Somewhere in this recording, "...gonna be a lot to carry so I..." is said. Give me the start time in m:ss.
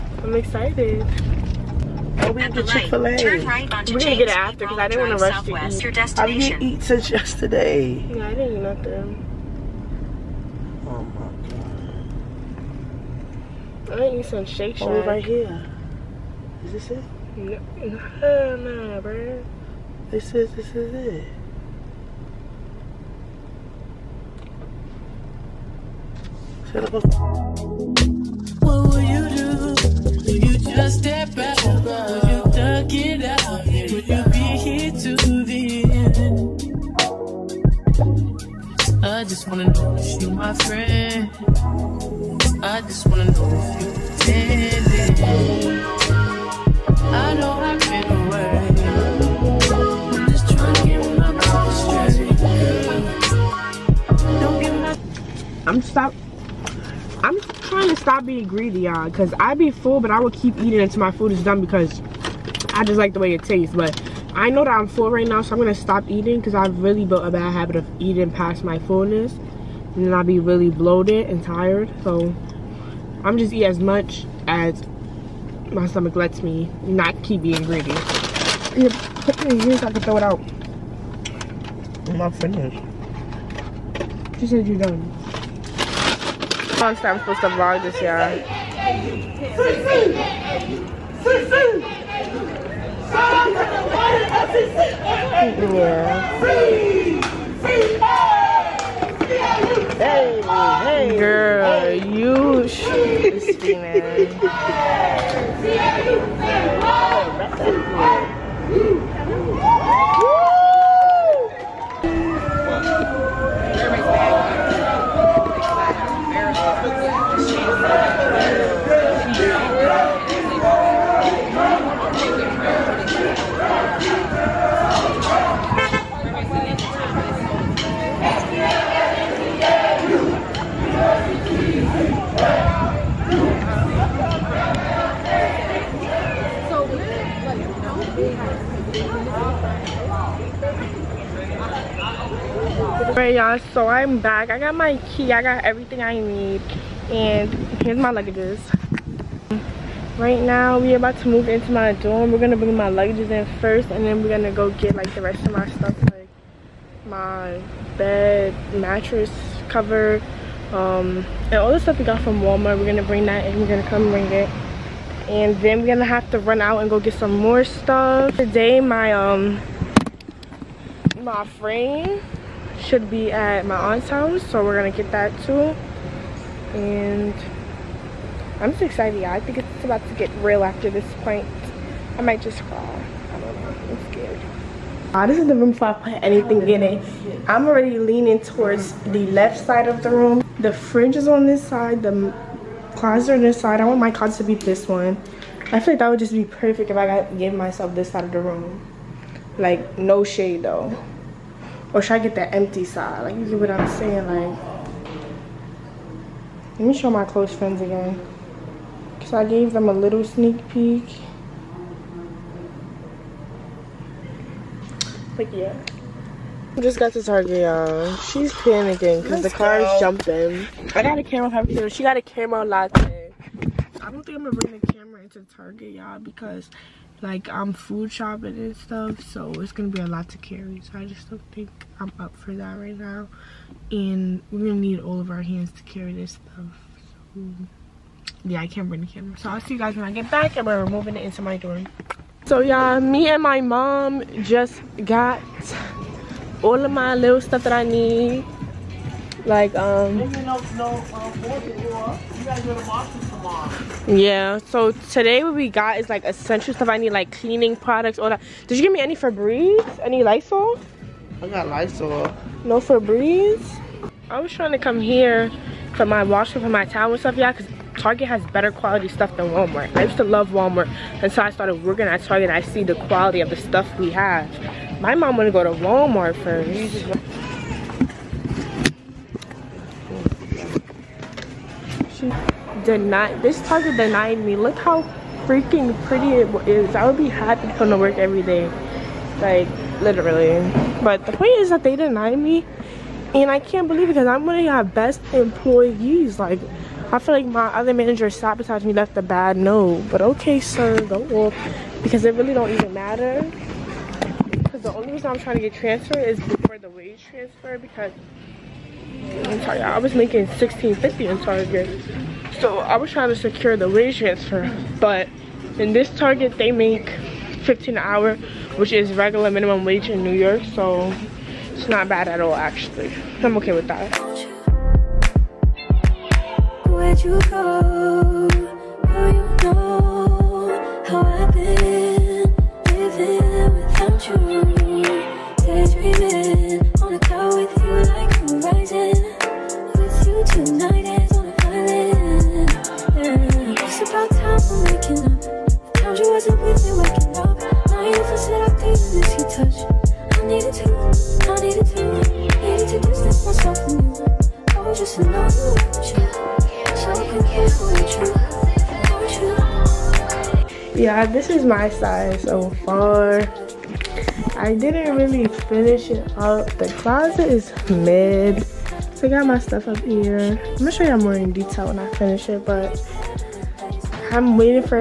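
3:49.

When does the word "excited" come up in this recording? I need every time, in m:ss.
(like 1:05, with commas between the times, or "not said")
0:00, 2:58.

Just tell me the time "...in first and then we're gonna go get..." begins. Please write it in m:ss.
2:33.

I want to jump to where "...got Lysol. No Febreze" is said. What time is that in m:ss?
4:21.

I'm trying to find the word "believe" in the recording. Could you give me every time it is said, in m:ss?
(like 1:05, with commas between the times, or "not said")
4:53.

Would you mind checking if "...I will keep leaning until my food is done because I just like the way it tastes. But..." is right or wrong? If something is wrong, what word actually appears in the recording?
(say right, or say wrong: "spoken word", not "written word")
wrong: "eating", not "leaning".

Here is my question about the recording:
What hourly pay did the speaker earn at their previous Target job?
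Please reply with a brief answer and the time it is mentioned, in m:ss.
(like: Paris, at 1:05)
$16.50, at 5:10.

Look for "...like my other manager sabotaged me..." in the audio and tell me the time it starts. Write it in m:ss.
4:57.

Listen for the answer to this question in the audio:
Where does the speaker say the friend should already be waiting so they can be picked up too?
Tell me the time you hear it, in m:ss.
2:53.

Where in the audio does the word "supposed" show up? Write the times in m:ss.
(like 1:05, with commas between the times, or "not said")
1:27.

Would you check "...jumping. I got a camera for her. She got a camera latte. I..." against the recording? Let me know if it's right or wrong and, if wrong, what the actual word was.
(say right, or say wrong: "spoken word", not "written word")
right.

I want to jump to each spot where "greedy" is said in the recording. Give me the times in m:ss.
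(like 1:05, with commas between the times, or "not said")
0:58, 1:17.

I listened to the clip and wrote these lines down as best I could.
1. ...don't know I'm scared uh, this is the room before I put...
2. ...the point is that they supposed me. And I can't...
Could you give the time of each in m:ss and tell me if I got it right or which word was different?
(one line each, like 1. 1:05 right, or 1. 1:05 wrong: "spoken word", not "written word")
1. 3:03 right
2. 4:51 wrong: "denied", not "supposed".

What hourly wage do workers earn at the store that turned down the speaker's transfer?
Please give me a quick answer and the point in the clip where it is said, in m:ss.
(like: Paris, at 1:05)
$15, at 5:17.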